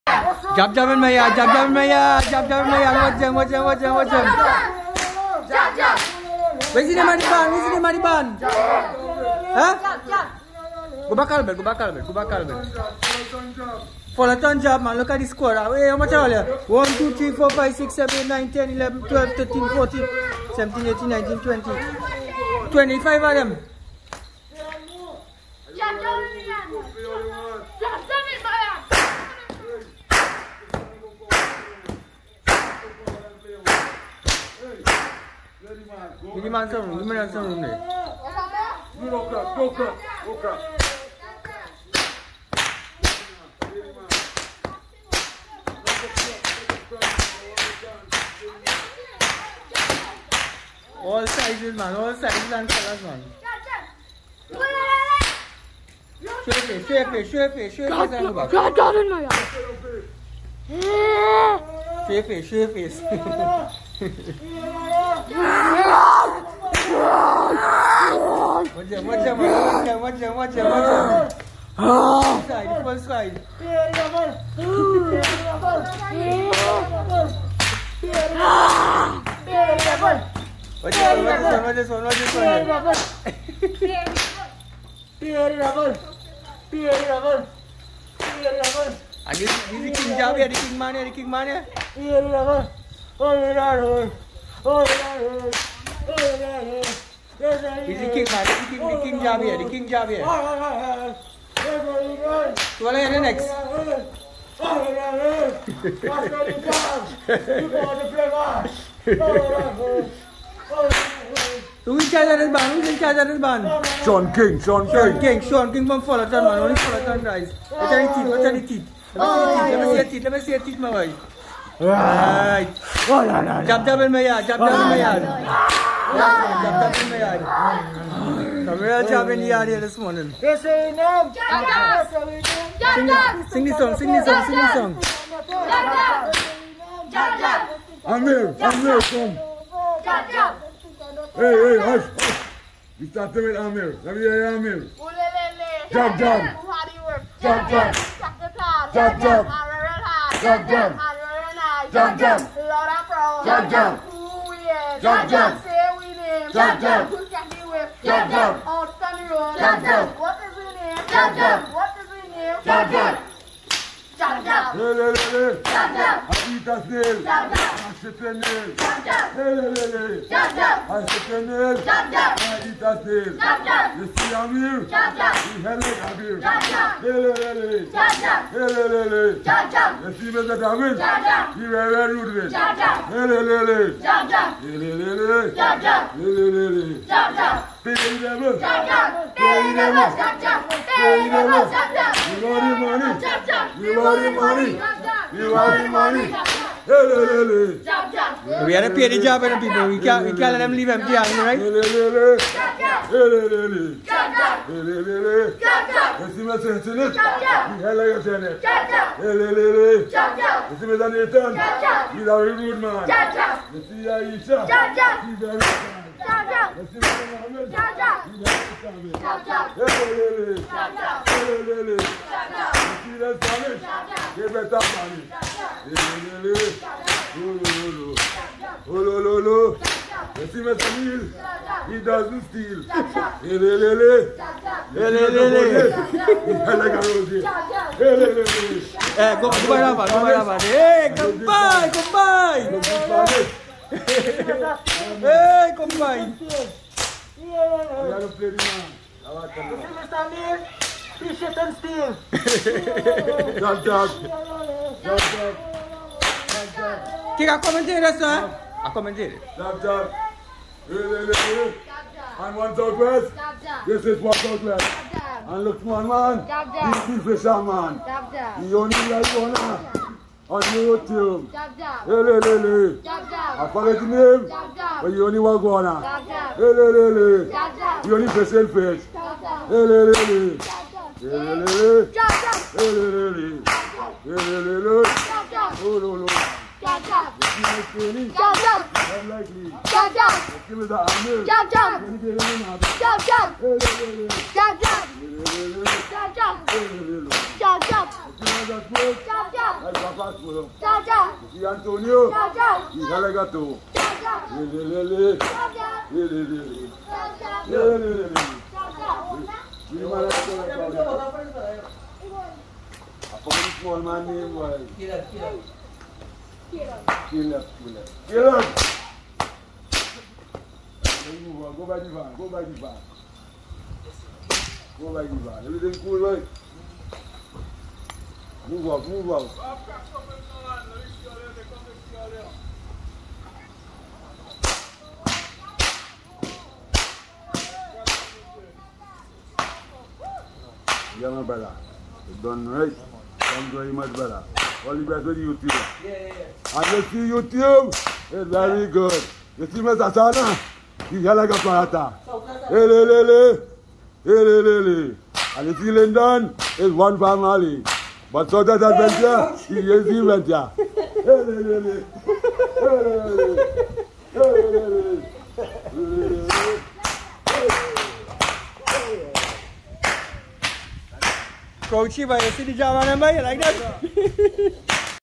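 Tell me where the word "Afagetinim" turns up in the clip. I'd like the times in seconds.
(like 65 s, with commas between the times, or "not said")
273 s.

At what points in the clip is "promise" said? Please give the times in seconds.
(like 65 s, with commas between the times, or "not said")
153 s.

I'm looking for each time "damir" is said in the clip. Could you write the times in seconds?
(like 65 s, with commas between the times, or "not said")
180 s.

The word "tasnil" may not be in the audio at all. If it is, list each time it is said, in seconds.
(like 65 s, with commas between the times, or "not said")
166 s, 172 s.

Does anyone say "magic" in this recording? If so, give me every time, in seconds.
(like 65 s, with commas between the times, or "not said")
not said.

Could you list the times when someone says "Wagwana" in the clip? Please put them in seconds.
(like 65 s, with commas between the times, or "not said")
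275 s.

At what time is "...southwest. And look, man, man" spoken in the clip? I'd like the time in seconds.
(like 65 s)
264 s.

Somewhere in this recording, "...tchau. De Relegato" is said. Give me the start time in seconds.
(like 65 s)
302 s.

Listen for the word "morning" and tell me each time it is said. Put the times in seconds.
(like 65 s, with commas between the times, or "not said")
129 s.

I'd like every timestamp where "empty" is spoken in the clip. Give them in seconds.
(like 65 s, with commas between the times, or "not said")
200 s.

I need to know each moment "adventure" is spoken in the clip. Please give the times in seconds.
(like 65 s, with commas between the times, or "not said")
358 s.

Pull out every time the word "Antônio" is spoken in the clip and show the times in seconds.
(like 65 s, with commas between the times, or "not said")
301 s.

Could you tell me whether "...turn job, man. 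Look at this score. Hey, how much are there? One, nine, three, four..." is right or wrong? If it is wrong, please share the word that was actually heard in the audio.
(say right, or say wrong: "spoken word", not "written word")
wrong: "two", not "nine".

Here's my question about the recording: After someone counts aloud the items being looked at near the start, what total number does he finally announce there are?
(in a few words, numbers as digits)
25.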